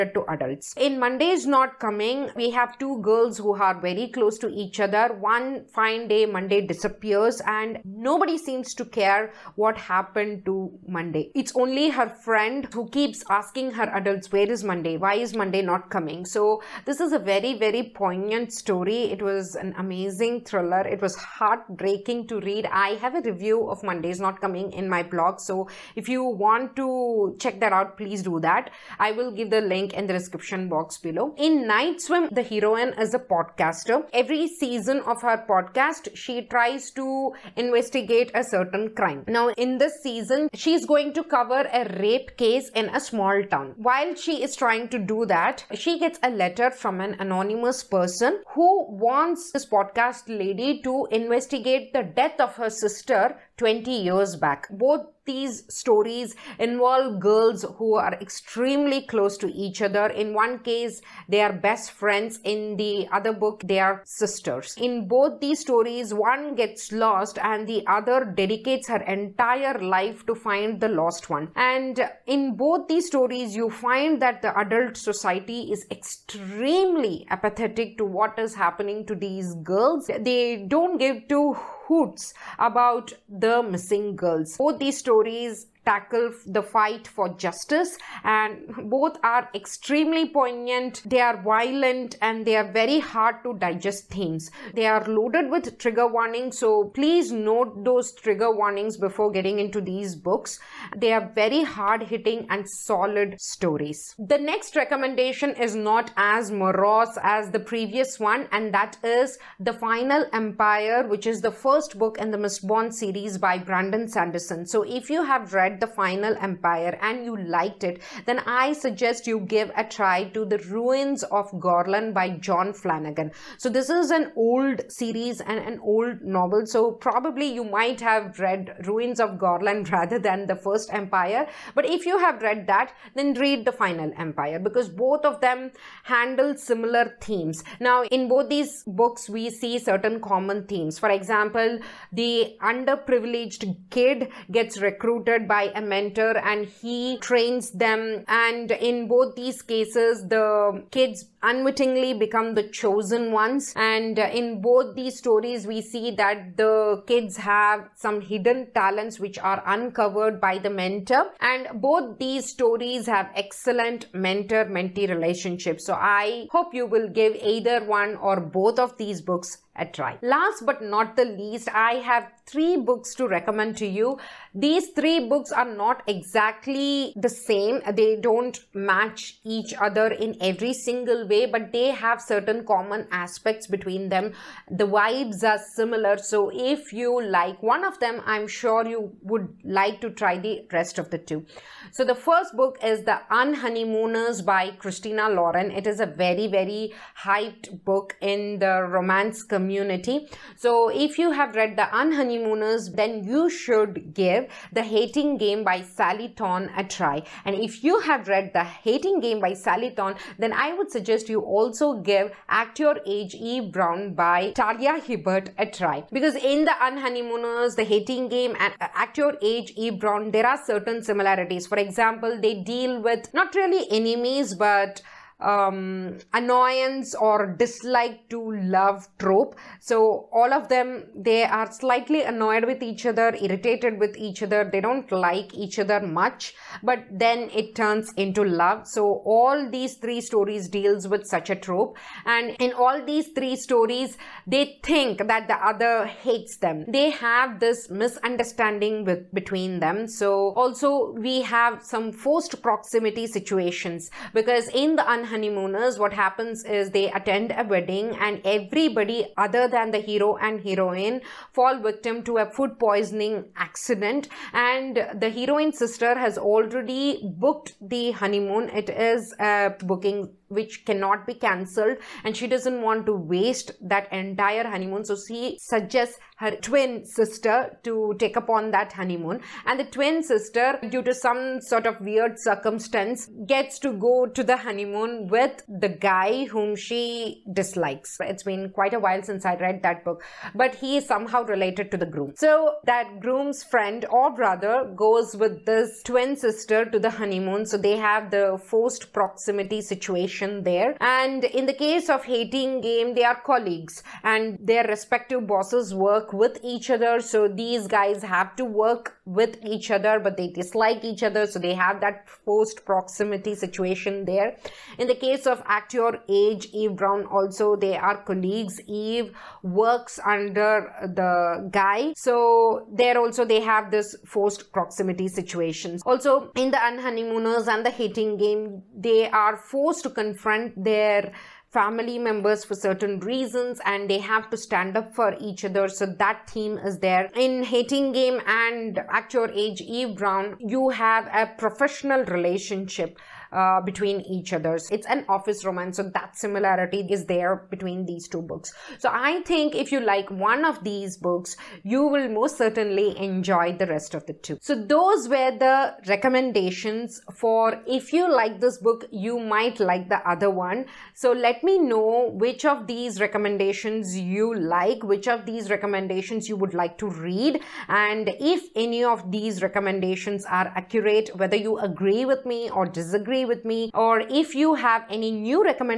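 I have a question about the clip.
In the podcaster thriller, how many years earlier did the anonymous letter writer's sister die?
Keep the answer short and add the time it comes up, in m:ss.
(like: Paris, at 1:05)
20, at 0:53.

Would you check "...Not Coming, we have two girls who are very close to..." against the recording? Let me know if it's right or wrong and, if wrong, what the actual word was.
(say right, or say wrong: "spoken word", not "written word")
right.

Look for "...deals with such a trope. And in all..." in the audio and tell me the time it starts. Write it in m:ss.
4:00.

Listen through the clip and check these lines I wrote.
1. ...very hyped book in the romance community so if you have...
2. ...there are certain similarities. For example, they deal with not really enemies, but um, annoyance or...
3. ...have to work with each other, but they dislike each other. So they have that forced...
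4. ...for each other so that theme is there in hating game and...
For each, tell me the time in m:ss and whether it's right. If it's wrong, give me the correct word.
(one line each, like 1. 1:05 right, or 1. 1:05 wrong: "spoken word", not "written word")
1. 3:16 right
2. 3:40 right
3. 5:08 right
4. 5:35 right.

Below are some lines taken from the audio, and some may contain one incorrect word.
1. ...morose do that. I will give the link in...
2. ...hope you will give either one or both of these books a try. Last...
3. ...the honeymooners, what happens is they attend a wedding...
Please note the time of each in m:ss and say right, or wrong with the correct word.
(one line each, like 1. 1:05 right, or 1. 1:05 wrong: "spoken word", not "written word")
1. 0:27 wrong: "please", not "morose"
2. 2:46 right
3. 4:14 right.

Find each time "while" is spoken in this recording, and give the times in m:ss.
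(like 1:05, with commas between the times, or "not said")
0:43, 4:48.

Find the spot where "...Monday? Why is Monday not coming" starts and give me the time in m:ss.
0:14.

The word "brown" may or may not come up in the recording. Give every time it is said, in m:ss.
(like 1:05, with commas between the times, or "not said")
3:33, 3:39, 5:16, 5:40.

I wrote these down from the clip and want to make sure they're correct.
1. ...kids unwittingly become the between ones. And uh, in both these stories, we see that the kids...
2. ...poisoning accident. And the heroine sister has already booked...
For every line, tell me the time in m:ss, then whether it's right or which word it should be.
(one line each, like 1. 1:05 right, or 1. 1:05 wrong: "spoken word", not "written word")
1. 2:30 wrong: "chosen", not "between"
2. 4:22 right.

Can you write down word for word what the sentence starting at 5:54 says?
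So those were the recommendations for if you like this book, you might like the other one.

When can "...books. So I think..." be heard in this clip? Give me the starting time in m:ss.
5:48.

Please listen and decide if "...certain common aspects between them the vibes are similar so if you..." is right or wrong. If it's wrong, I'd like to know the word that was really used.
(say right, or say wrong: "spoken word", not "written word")
right.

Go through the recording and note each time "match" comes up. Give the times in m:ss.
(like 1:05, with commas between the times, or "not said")
2:58.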